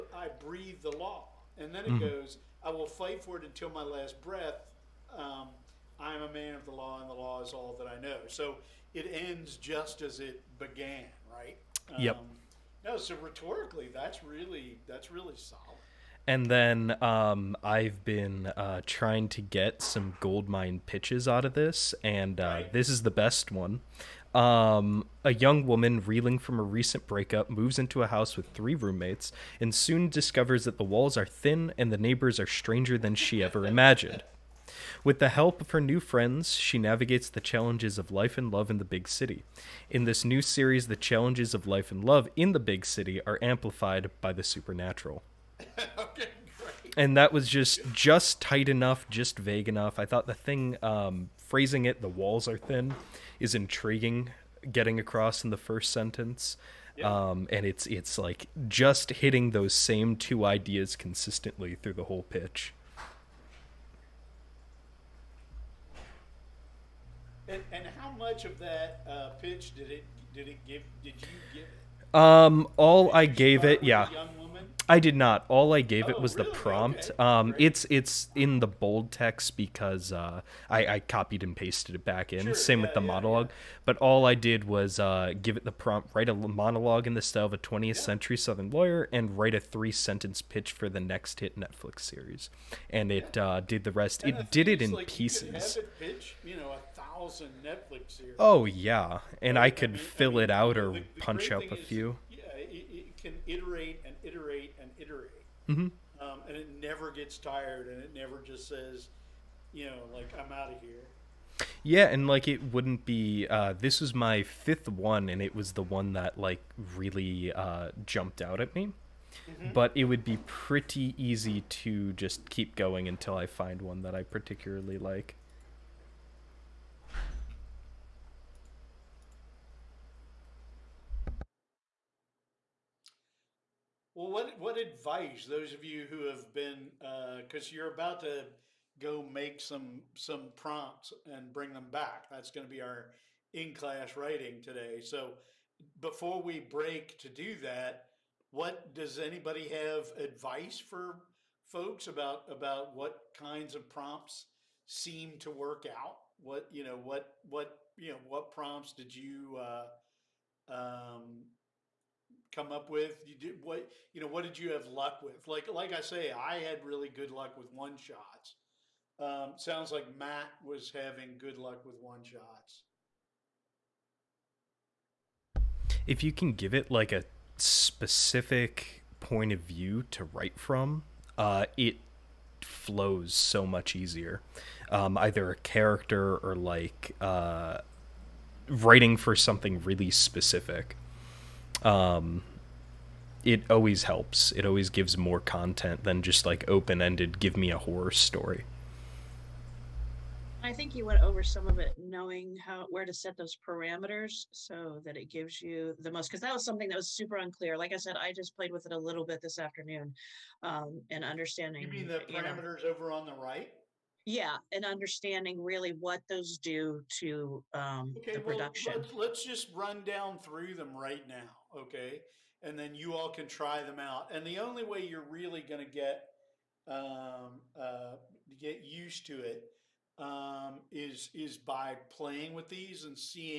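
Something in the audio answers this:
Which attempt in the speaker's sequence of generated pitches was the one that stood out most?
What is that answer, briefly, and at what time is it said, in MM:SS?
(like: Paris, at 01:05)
Fifth, at 01:54.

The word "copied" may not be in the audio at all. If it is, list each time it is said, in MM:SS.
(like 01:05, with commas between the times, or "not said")
01:20.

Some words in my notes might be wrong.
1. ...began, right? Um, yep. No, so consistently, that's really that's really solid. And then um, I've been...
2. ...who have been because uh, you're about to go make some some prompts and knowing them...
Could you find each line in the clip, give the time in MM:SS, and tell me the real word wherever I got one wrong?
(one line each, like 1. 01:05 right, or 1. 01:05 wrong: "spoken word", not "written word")
1. 00:10 wrong: "rhetorically", not "consistently"
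2. 02:16 wrong: "bring", not "knowing".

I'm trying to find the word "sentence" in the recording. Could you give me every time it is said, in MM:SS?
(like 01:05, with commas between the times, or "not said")
00:55, 01:29.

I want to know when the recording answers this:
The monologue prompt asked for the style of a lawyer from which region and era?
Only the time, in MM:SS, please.
01:27.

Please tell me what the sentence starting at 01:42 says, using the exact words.
Yeah, it, it, can iterate and iterate and iterate, mm-hmm.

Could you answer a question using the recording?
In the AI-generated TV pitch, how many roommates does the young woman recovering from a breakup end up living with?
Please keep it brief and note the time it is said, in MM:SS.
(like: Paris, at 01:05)
3, at 00:28.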